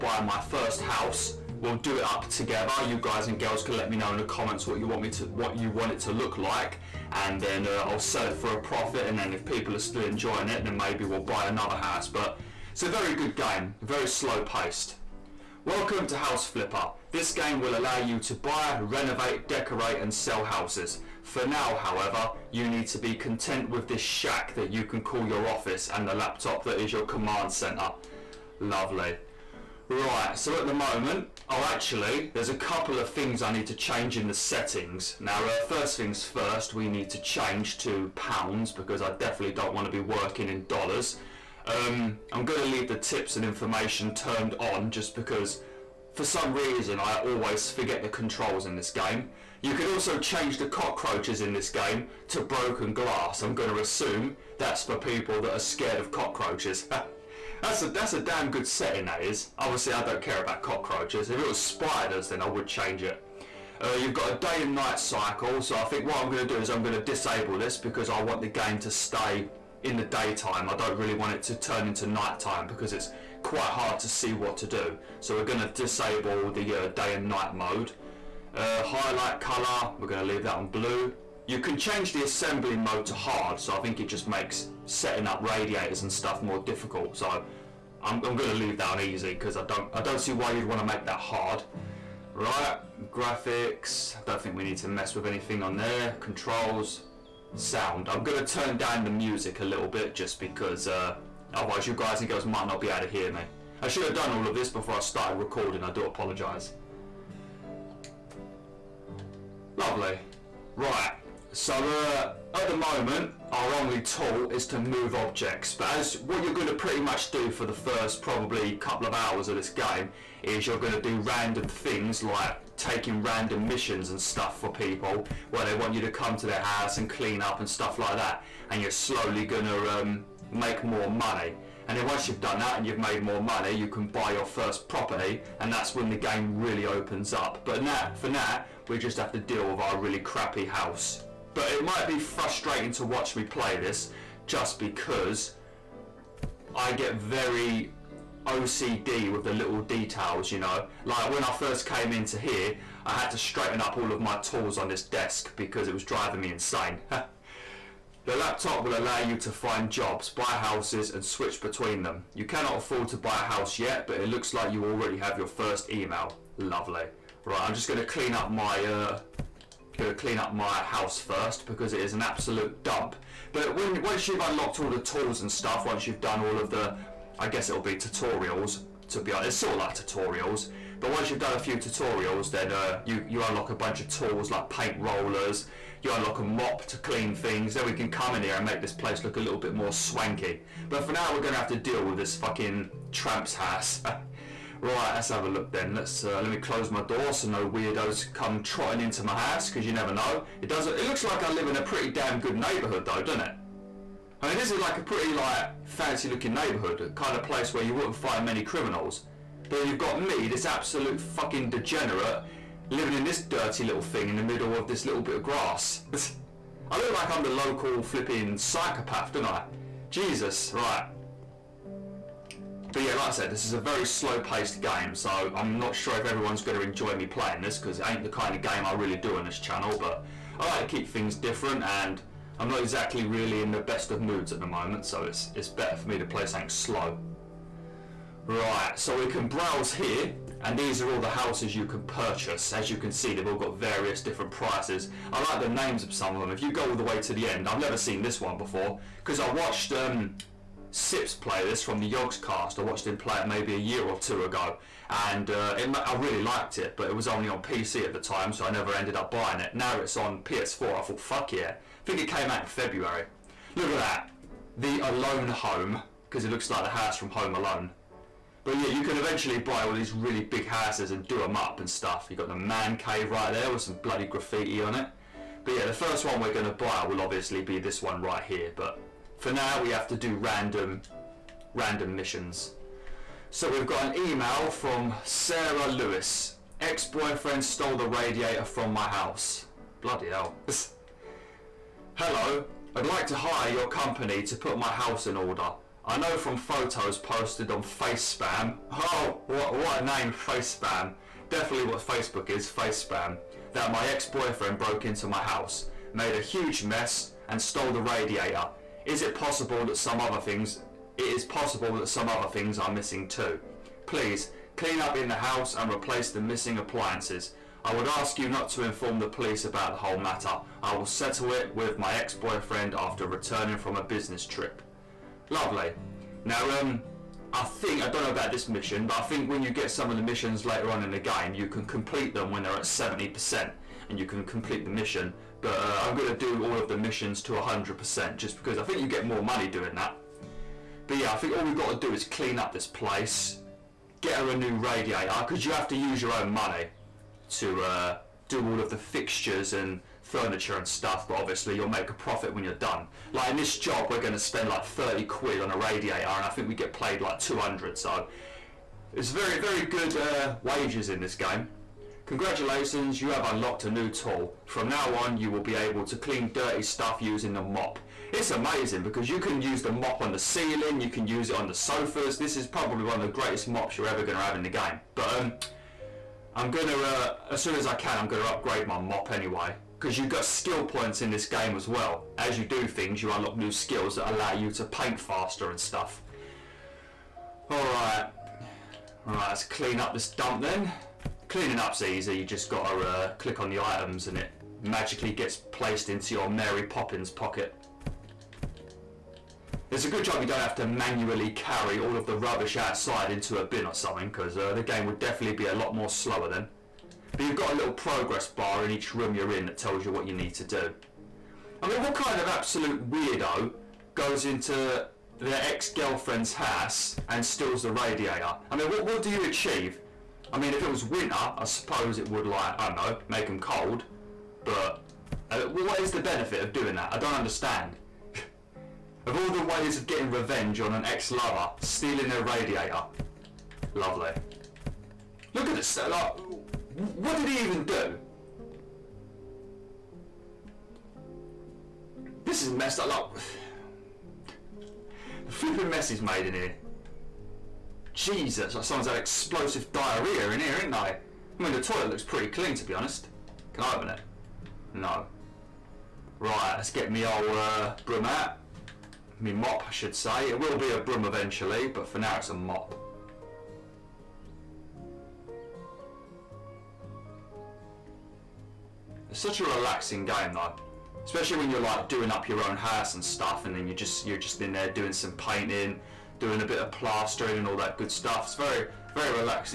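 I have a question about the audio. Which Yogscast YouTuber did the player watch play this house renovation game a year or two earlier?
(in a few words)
Sips.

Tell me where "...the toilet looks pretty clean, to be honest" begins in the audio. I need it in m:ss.
7:31.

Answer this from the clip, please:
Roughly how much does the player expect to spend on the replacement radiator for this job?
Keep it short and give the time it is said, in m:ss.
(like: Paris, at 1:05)
£30, at 5:54.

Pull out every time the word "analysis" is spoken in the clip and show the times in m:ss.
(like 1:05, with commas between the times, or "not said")
not said.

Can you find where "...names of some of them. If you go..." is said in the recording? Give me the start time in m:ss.
4:05.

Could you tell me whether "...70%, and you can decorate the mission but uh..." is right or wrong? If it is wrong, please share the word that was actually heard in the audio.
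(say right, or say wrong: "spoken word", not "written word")
wrong: "complete", not "decorate".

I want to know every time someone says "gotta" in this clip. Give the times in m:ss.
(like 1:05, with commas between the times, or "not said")
2:49, 6:32.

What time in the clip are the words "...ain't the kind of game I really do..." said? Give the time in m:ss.
3:48.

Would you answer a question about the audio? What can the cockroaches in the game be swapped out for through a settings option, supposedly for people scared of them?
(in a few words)
Broken glass.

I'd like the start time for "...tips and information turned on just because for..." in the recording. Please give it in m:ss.
0:42.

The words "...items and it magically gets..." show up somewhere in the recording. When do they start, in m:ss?
6:33.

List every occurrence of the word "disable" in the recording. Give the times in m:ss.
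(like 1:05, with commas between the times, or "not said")
1:07, 1:15.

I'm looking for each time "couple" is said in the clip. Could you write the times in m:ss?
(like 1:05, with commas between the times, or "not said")
0:32, 1:58.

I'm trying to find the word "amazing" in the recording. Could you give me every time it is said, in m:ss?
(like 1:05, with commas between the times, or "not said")
6:08.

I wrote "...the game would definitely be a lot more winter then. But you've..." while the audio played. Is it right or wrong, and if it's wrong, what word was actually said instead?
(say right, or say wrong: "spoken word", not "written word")
wrong: "slower", not "winter".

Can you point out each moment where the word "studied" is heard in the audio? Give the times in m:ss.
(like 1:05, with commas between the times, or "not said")
not said.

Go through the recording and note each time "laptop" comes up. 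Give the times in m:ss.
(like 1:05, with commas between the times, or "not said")
0:26, 2:38.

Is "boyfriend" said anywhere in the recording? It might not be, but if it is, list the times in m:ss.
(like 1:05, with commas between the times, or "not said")
4:46, 5:04, 5:22.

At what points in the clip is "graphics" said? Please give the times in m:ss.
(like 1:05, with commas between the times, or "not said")
1:33.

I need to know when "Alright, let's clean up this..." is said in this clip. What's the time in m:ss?
6:29.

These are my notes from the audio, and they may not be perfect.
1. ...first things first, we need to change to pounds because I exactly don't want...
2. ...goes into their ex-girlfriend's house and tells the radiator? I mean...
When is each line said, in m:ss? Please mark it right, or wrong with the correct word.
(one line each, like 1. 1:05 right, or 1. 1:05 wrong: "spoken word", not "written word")
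1. 0:35 wrong: "definitely", not "exactly"
2. 6:54 wrong: "steals", not "tells".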